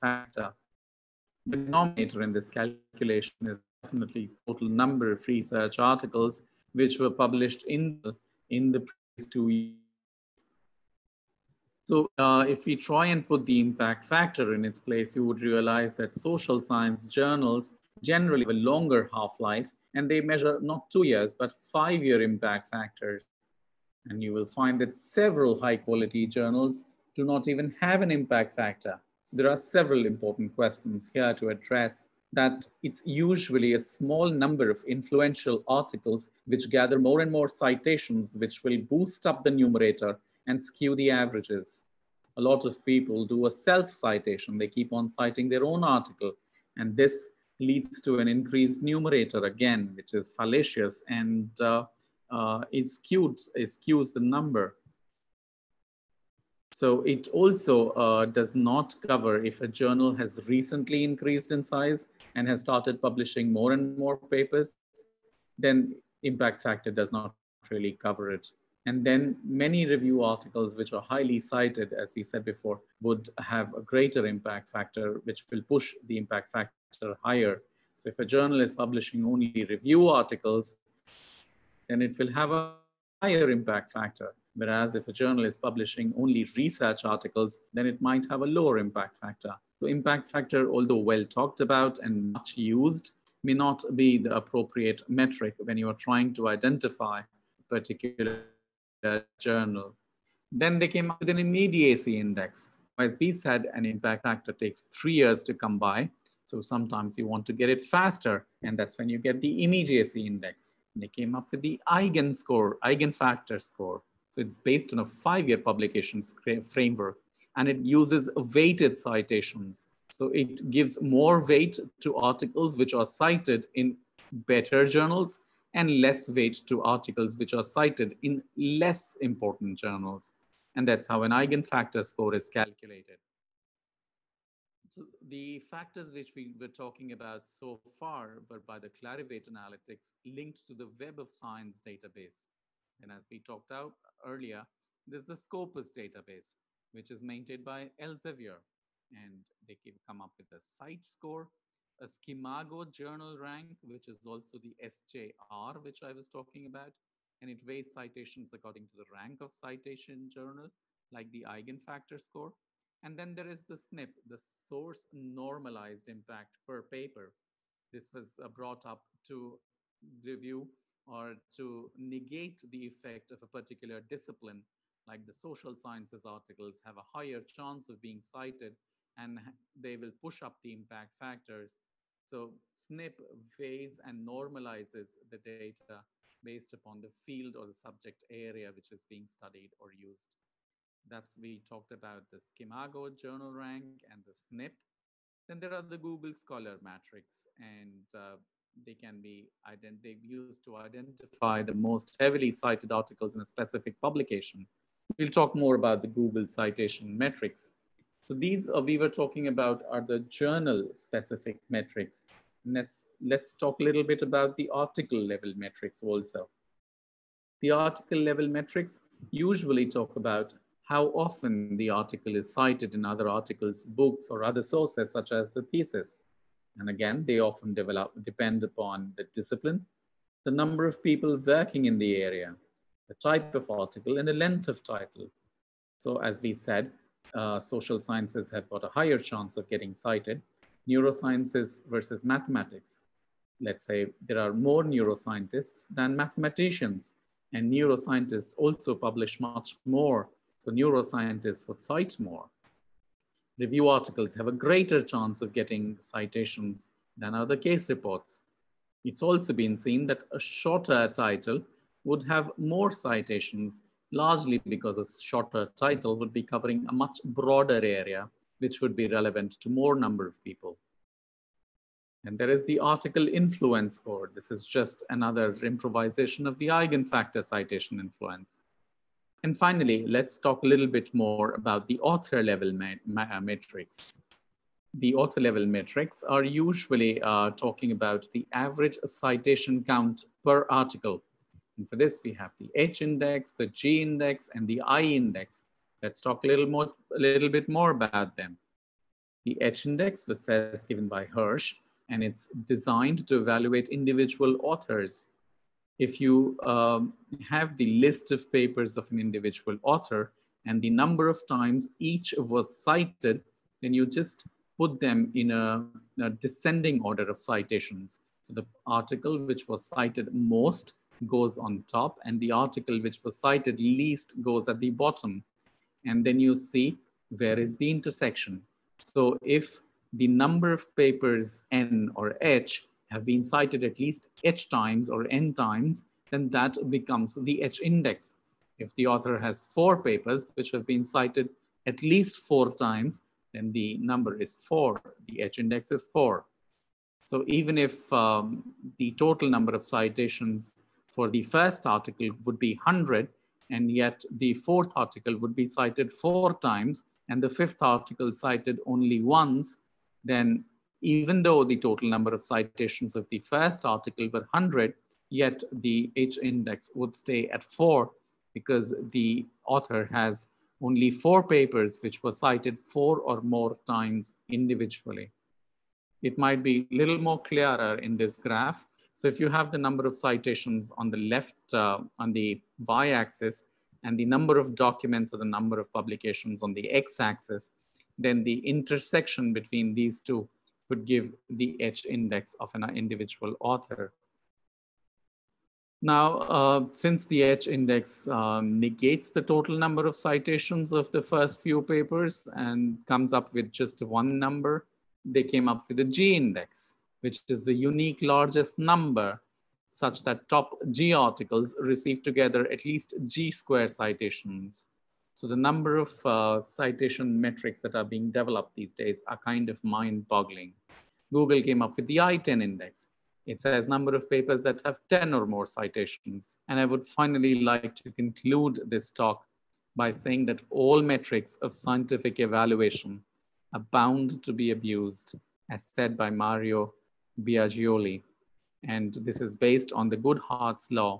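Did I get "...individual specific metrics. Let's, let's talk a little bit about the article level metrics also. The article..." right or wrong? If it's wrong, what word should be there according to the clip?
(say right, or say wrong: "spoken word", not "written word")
wrong: "journal", not "individual".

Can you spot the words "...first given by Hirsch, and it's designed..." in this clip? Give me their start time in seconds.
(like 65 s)
300 s.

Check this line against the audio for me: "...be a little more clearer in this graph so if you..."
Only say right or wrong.
right.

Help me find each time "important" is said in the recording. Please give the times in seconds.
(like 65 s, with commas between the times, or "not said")
30 s, 129 s.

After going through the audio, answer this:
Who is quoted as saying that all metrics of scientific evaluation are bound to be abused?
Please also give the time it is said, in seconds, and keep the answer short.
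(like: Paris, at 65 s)
Mario Biagioli, at 436 s.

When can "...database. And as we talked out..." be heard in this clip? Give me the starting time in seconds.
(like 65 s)
141 s.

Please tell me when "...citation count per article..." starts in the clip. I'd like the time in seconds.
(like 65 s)
289 s.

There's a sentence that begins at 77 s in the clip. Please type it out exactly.
So if a journal is publishing only review articles, then it will have a higher impact factor.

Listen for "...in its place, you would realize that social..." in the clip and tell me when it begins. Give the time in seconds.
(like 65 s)
14 s.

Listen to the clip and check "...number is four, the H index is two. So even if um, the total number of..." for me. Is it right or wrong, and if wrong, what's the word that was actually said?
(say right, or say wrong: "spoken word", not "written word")
wrong: "four", not "two".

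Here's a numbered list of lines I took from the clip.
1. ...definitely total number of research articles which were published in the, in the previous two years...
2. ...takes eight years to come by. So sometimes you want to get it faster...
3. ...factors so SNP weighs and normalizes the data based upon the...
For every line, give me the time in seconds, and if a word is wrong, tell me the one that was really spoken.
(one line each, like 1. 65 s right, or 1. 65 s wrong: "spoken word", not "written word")
1. 3 s right
2. 104 s wrong: "three", not "eight"
3. 181 s right.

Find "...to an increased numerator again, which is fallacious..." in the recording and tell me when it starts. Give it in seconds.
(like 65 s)
48 s.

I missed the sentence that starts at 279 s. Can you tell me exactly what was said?
And finally, let's talk a little bit more about the author level matrix.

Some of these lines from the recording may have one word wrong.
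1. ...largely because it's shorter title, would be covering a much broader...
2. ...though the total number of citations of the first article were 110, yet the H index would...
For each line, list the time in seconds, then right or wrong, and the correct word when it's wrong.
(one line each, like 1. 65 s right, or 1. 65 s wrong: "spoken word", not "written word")
1. 264 s right
2. 361 s wrong: "100", not "110".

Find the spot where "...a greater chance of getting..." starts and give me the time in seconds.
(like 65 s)
254 s.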